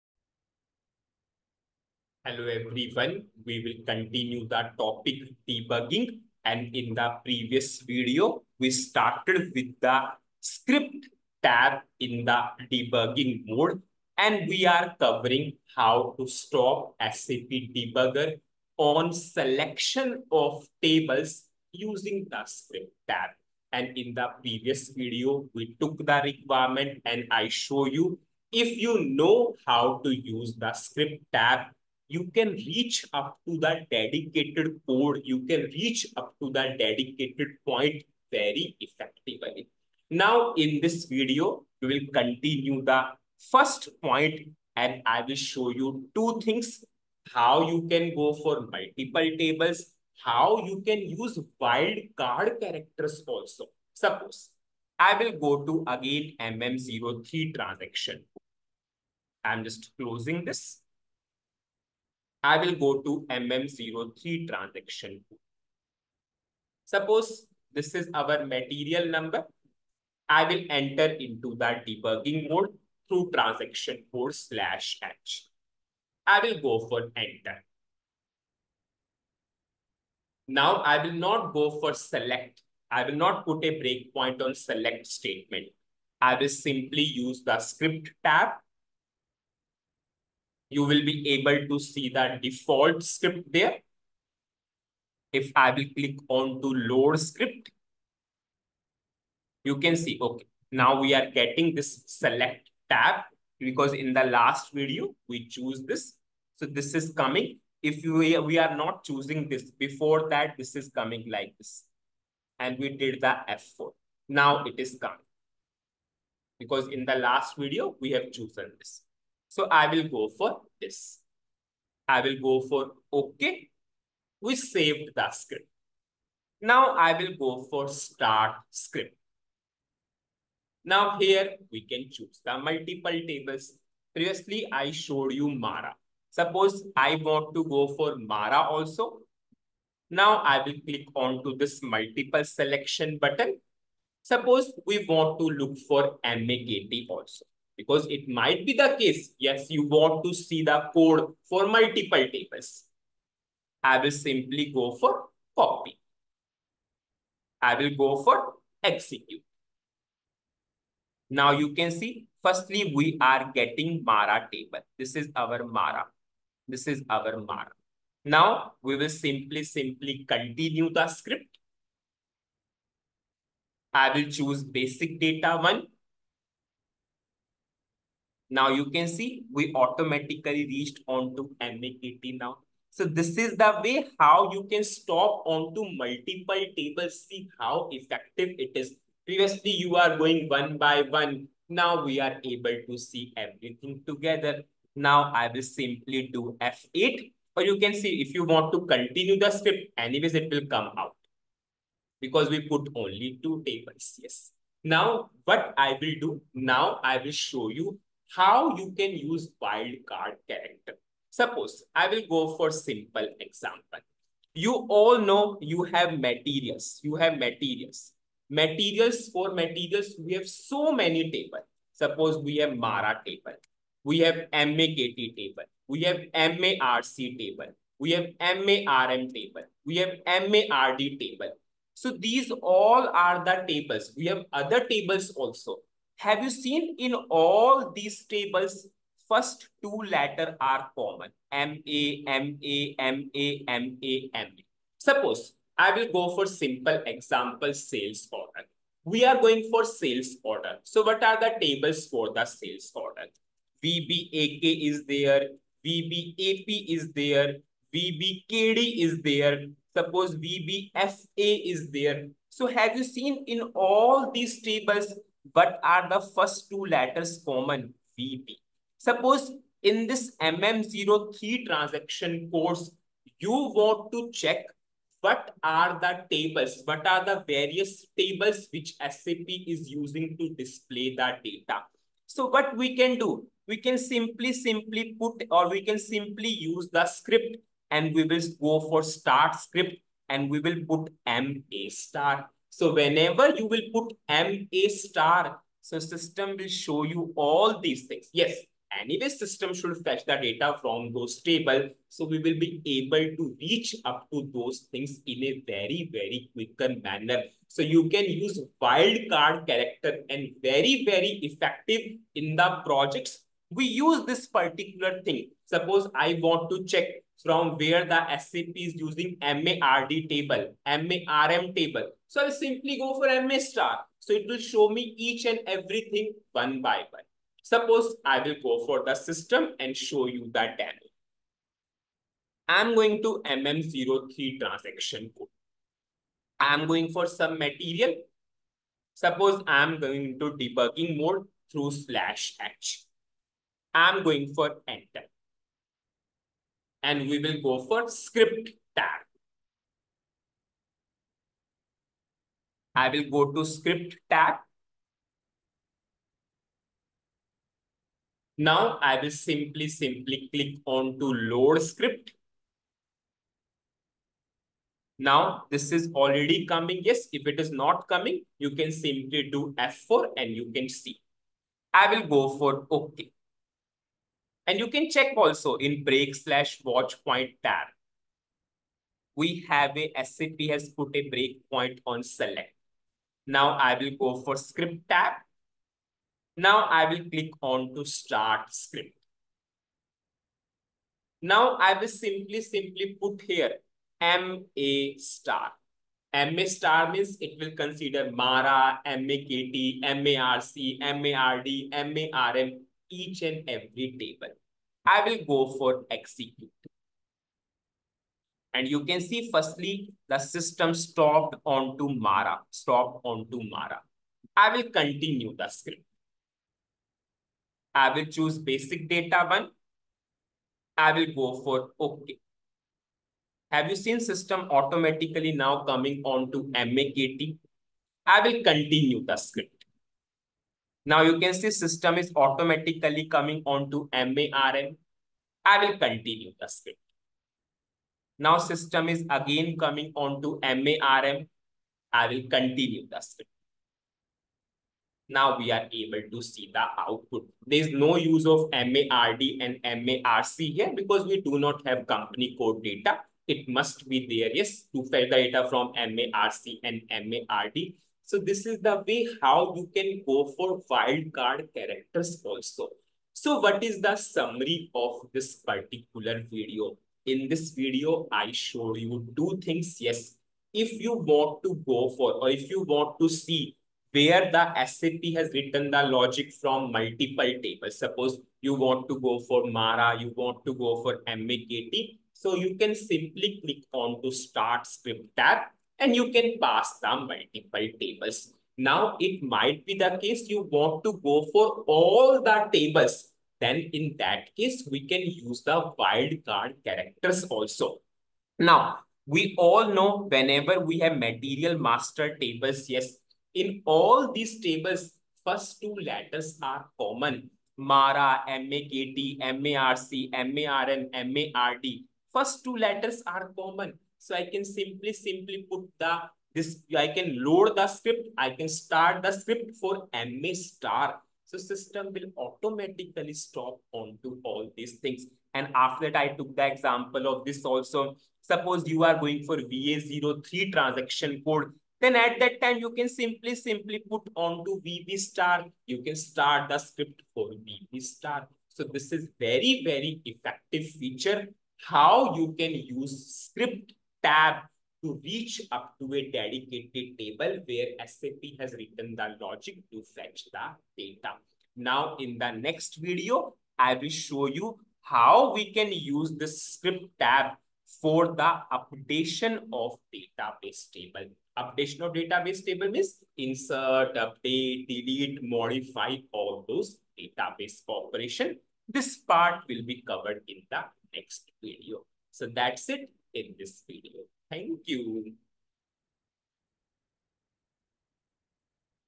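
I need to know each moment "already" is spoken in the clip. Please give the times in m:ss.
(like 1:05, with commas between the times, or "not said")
6:06.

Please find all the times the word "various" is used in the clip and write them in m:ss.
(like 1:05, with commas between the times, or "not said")
4:37.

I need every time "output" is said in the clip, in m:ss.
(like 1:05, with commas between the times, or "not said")
7:26.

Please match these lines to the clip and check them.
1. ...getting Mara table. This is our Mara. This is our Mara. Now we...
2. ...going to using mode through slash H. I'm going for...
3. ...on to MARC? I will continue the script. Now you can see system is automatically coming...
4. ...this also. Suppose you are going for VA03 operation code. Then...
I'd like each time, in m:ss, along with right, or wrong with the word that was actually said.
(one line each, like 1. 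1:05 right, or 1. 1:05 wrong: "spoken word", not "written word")
1. 2:43 right
2. 5:39 wrong: "debugging", not "using"
3. 7:06 wrong: "MAKT", not "MARC"
4. 8:47 wrong: "transaction", not "operation".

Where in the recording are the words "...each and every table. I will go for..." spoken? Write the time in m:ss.
6:43.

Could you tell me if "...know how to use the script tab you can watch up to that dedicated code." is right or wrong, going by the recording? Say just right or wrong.
wrong.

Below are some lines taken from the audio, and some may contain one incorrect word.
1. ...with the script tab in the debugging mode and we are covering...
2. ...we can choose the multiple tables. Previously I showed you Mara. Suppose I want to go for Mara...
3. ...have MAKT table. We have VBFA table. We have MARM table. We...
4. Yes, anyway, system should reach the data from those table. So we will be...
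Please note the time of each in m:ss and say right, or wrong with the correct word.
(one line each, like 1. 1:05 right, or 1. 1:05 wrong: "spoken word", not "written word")
1. 0:09 right
2. 2:11 right
3. 3:44 wrong: "MARC", not "VBFA"
4. 4:58 wrong: "fetch", not "reach".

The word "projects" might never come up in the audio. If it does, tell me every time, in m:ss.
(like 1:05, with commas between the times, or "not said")
5:12.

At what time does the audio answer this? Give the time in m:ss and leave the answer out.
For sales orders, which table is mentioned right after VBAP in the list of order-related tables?
4:17.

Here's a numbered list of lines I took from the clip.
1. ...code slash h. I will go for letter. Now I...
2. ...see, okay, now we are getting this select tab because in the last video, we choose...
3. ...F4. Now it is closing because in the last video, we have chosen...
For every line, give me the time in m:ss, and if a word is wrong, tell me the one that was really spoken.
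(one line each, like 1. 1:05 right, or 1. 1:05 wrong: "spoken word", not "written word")
1. 1:14 wrong: "enter", not "letter"
2. 1:39 right
3. 1:53 wrong: "coming", not "closing".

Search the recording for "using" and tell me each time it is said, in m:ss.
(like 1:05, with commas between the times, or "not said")
0:21, 4:39, 5:18.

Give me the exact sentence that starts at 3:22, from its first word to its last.
Because we put only two tables, yes.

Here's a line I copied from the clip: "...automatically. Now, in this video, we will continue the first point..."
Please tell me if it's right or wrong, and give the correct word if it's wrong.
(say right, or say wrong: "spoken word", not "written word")
wrong: "effectively", not "automatically".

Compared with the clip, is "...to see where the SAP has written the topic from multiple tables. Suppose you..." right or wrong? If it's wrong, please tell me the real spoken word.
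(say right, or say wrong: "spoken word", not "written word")
wrong: "logic", not "topic".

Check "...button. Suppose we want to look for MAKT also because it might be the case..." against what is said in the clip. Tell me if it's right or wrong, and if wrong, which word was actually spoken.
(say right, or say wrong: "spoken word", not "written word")
right.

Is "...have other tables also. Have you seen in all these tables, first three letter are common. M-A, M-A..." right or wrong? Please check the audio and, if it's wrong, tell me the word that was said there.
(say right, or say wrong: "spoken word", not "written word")
wrong: "two", not "three".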